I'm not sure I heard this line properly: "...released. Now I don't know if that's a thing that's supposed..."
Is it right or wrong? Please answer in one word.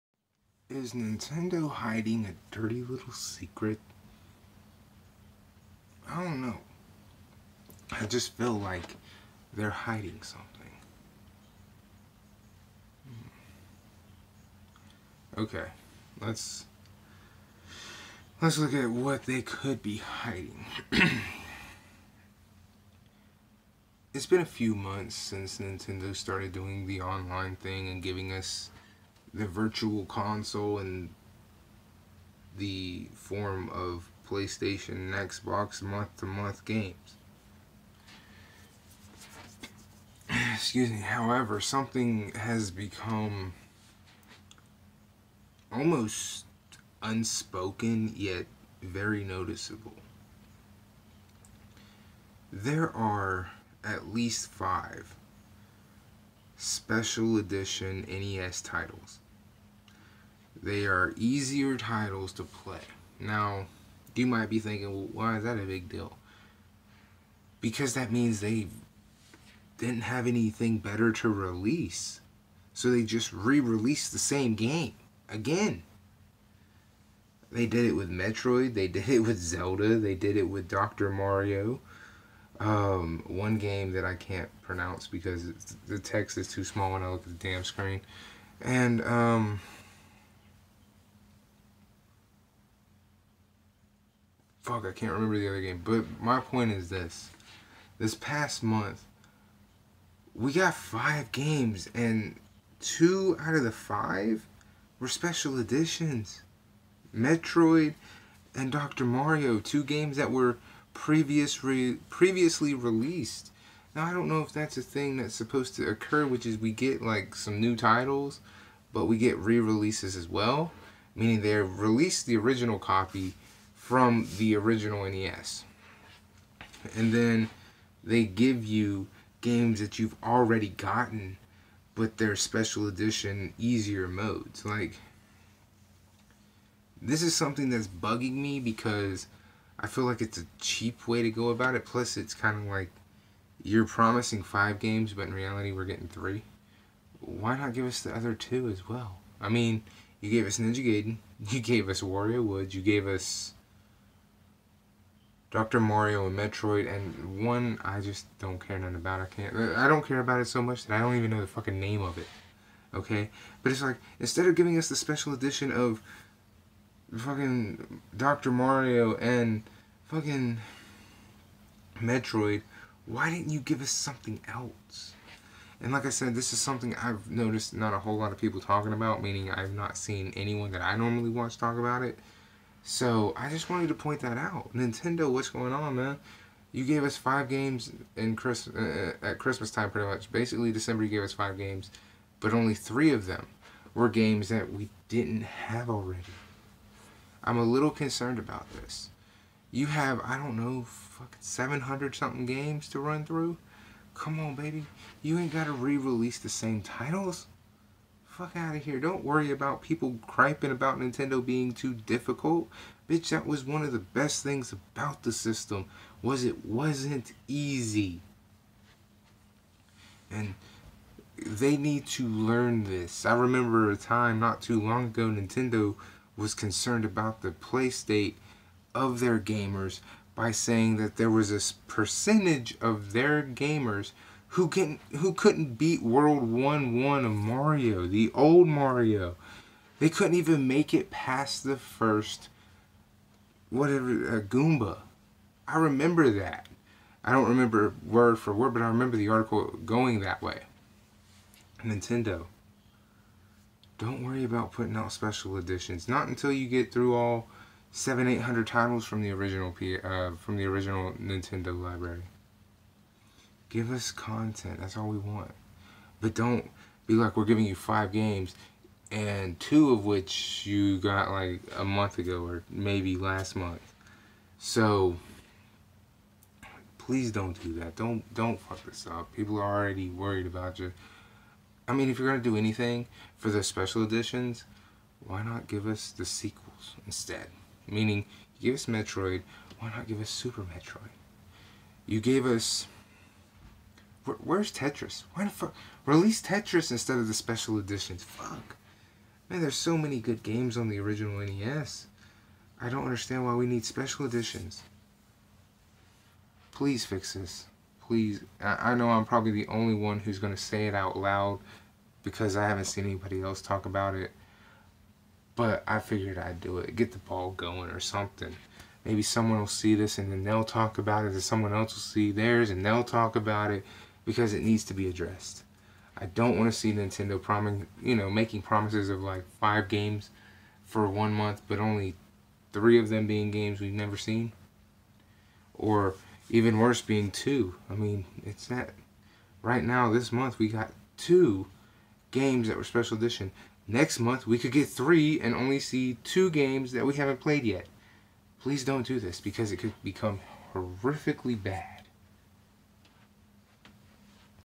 right.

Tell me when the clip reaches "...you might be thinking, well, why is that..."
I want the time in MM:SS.
01:04.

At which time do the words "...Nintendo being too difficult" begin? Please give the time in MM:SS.
03:30.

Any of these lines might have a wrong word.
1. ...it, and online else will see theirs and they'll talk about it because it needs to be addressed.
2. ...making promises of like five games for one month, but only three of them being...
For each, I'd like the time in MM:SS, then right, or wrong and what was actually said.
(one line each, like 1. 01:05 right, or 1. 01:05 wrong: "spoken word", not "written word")
1. 05:21 wrong: "someone", not "online"
2. 05:28 right.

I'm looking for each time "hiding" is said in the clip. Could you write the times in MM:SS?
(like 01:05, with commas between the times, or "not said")
00:01, 00:09, 00:19.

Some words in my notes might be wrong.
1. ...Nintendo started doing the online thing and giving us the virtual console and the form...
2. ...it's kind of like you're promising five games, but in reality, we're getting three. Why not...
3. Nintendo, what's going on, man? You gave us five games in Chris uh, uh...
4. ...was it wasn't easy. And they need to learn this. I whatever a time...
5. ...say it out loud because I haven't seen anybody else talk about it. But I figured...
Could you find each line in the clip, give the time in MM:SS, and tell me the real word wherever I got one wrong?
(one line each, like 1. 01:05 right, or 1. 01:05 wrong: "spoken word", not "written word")
1. 00:25 right
2. 02:22 right
3. 03:04 right
4. 03:36 wrong: "remember", not "whatever"
5. 05:10 right.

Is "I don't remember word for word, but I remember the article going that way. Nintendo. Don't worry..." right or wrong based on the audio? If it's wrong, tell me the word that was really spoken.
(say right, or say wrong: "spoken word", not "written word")
right.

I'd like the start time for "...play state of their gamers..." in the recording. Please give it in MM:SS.
03:47.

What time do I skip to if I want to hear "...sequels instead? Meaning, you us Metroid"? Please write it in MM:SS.
04:46.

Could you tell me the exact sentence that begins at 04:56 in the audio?
Release Tetris instead of the special editions.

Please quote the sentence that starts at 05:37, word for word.
I mean, it's that right now.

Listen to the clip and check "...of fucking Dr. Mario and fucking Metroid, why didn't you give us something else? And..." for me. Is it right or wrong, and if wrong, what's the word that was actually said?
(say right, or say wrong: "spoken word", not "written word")
right.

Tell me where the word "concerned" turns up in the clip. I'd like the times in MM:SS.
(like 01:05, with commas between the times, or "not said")
03:17, 03:46.